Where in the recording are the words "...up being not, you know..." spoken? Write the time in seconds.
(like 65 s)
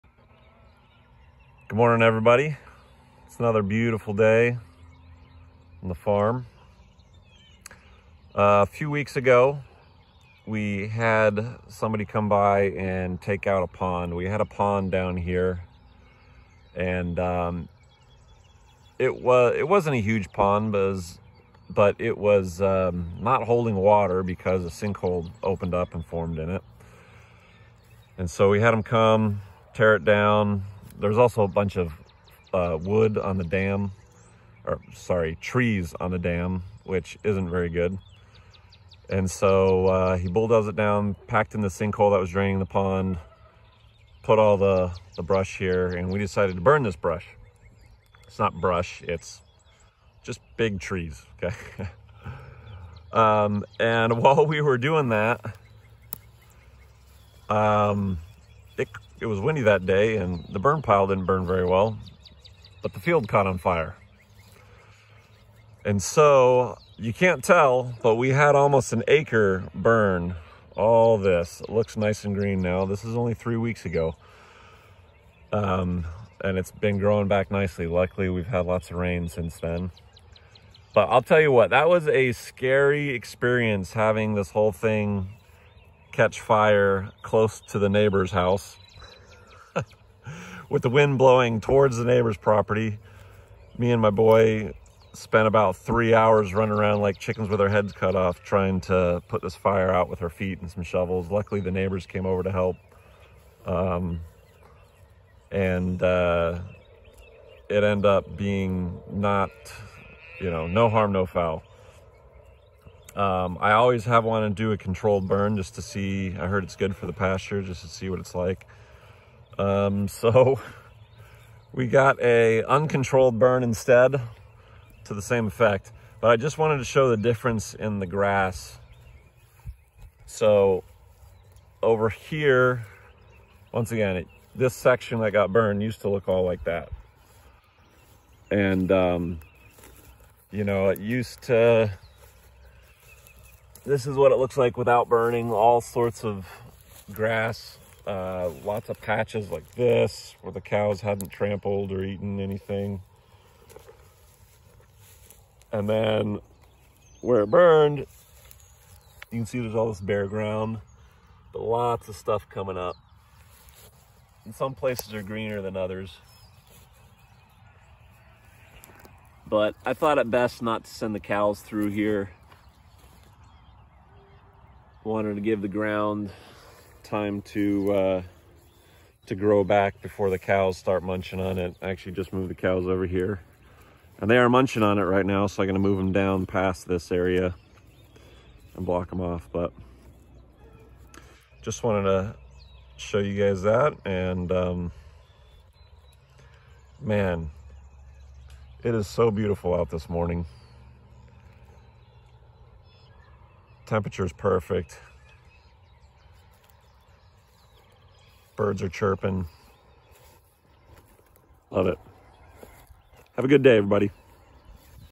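108 s.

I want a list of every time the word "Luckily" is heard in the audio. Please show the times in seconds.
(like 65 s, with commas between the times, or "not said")
77 s, 101 s.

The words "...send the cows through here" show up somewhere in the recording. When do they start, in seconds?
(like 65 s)
170 s.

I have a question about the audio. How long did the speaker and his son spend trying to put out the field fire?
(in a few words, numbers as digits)
3 hours.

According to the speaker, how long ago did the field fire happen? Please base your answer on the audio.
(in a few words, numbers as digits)
3 weeks.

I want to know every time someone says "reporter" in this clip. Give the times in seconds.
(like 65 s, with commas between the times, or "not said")
not said.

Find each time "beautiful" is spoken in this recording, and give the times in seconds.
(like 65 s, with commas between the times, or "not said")
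3 s, 199 s.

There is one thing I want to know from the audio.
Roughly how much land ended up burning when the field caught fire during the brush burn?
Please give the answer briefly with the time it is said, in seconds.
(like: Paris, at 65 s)
Almost an acre, at 68 s.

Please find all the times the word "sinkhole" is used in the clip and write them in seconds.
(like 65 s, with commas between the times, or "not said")
24 s, 41 s.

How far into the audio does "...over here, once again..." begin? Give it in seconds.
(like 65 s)
131 s.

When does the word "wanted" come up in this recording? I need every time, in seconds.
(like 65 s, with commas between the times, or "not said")
114 s, 126 s, 175 s, 191 s.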